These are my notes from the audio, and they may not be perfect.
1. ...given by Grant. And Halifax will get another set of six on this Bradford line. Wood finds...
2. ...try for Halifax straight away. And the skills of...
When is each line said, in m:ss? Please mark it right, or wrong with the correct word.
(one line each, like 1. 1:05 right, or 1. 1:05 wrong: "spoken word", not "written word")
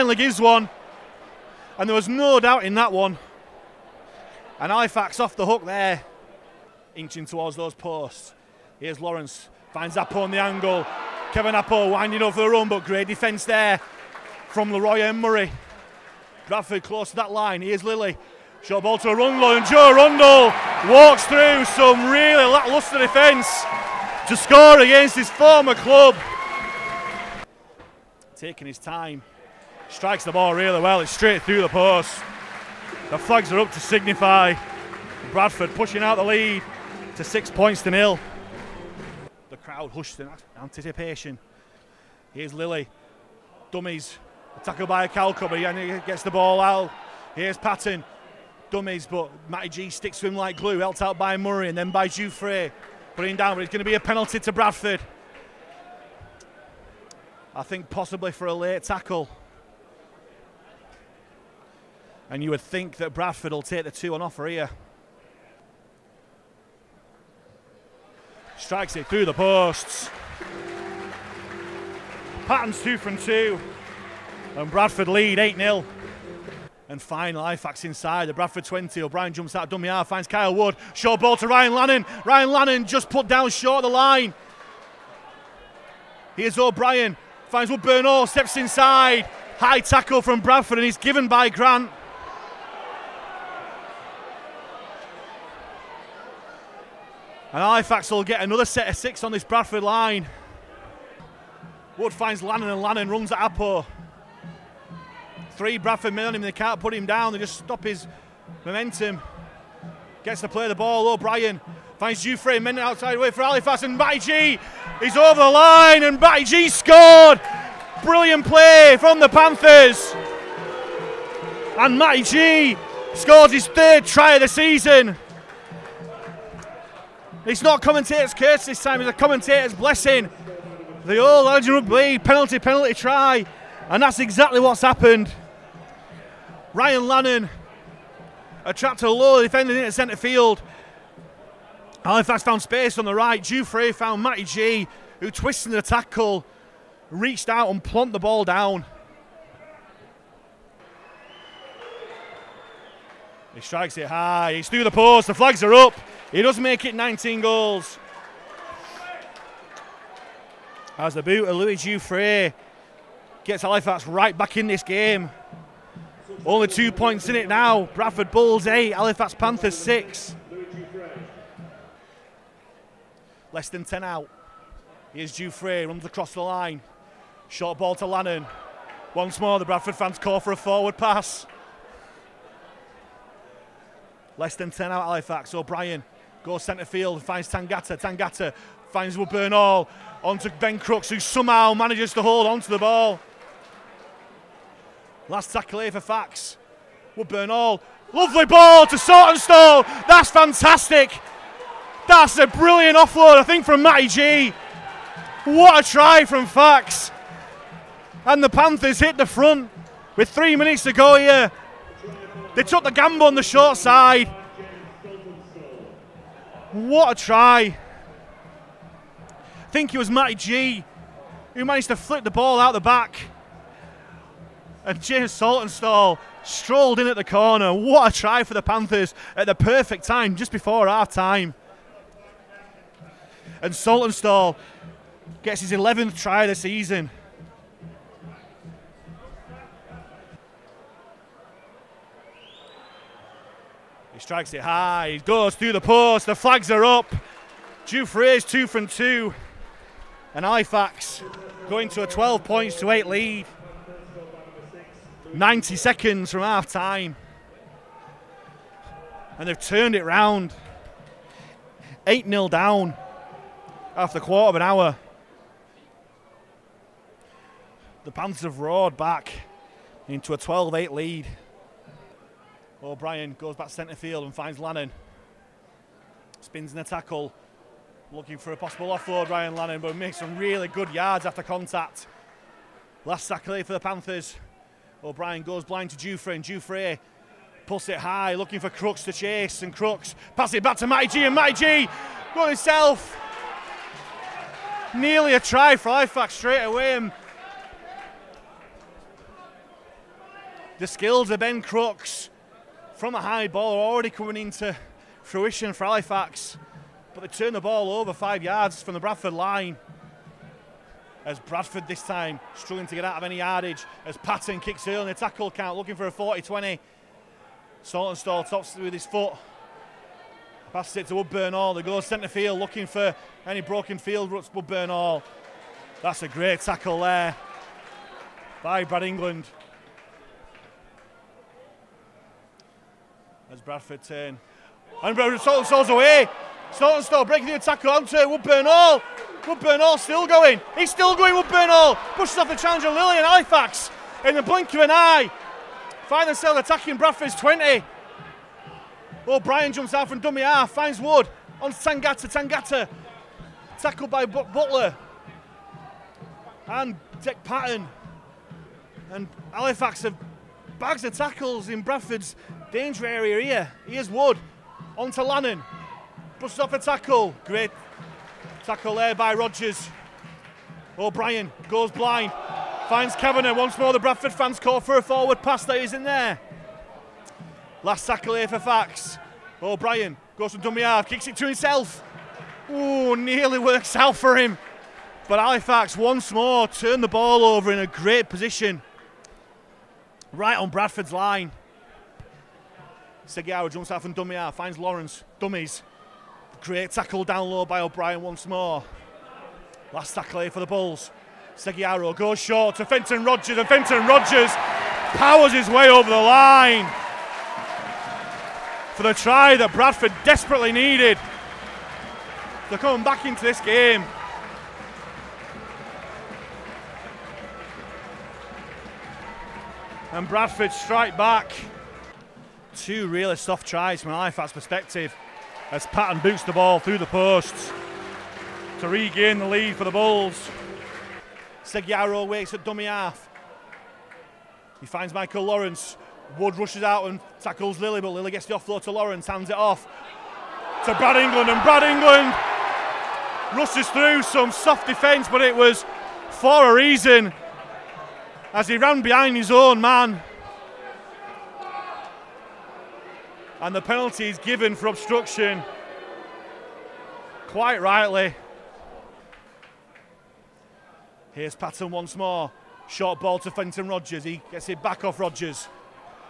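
1. 1:30 right
2. 4:55 right.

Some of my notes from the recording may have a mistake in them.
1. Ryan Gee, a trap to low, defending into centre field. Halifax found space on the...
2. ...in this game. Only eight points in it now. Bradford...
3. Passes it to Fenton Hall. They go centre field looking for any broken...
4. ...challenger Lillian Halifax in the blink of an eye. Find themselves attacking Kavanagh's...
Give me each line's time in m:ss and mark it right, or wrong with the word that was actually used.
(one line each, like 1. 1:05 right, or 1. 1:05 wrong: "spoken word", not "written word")
1. 2:16 wrong: "Lannon", not "Gee"
2. 2:44 wrong: "two", not "eight"
3. 5:20 wrong: "Woodburn", not "Fenton"
4. 5:42 wrong: "Bradford", not "Kavanagh".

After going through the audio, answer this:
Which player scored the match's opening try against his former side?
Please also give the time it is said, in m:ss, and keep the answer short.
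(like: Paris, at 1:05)
Joe Arundel, at 0:19.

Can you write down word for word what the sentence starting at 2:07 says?
It's not commentator's curse this time, it's a commentator's blessing.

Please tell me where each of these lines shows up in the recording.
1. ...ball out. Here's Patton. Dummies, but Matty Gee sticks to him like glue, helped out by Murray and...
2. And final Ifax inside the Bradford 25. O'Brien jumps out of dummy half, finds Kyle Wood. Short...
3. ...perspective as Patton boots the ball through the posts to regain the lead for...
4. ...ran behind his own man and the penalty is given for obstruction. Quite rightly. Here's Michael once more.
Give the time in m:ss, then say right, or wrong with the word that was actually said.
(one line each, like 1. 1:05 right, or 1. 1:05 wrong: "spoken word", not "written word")
1. 0:46 right
2. 1:16 wrong: "20", not "25"
3. 7:04 right
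4. 7:28 wrong: "Patton", not "Michael".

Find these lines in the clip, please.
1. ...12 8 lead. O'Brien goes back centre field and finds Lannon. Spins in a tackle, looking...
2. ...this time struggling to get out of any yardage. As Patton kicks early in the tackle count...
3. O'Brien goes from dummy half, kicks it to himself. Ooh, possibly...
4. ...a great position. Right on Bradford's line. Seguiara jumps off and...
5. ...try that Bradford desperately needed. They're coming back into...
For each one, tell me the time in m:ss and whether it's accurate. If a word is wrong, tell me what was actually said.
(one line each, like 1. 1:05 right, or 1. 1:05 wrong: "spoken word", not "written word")
1. 4:30 right
2. 5:11 right
3. 6:19 wrong: "nearly", not "possibly"
4. 6:27 right
5. 6:49 right.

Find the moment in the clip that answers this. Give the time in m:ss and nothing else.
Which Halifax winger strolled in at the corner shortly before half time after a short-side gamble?
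3:45.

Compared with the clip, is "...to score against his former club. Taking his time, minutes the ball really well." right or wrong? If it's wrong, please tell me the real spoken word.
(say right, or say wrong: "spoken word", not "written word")
wrong: "strikes", not "minutes".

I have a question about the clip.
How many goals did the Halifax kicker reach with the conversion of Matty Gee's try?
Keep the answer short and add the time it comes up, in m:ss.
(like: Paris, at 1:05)
19, at 2:36.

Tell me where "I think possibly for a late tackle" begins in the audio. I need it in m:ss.
0:57.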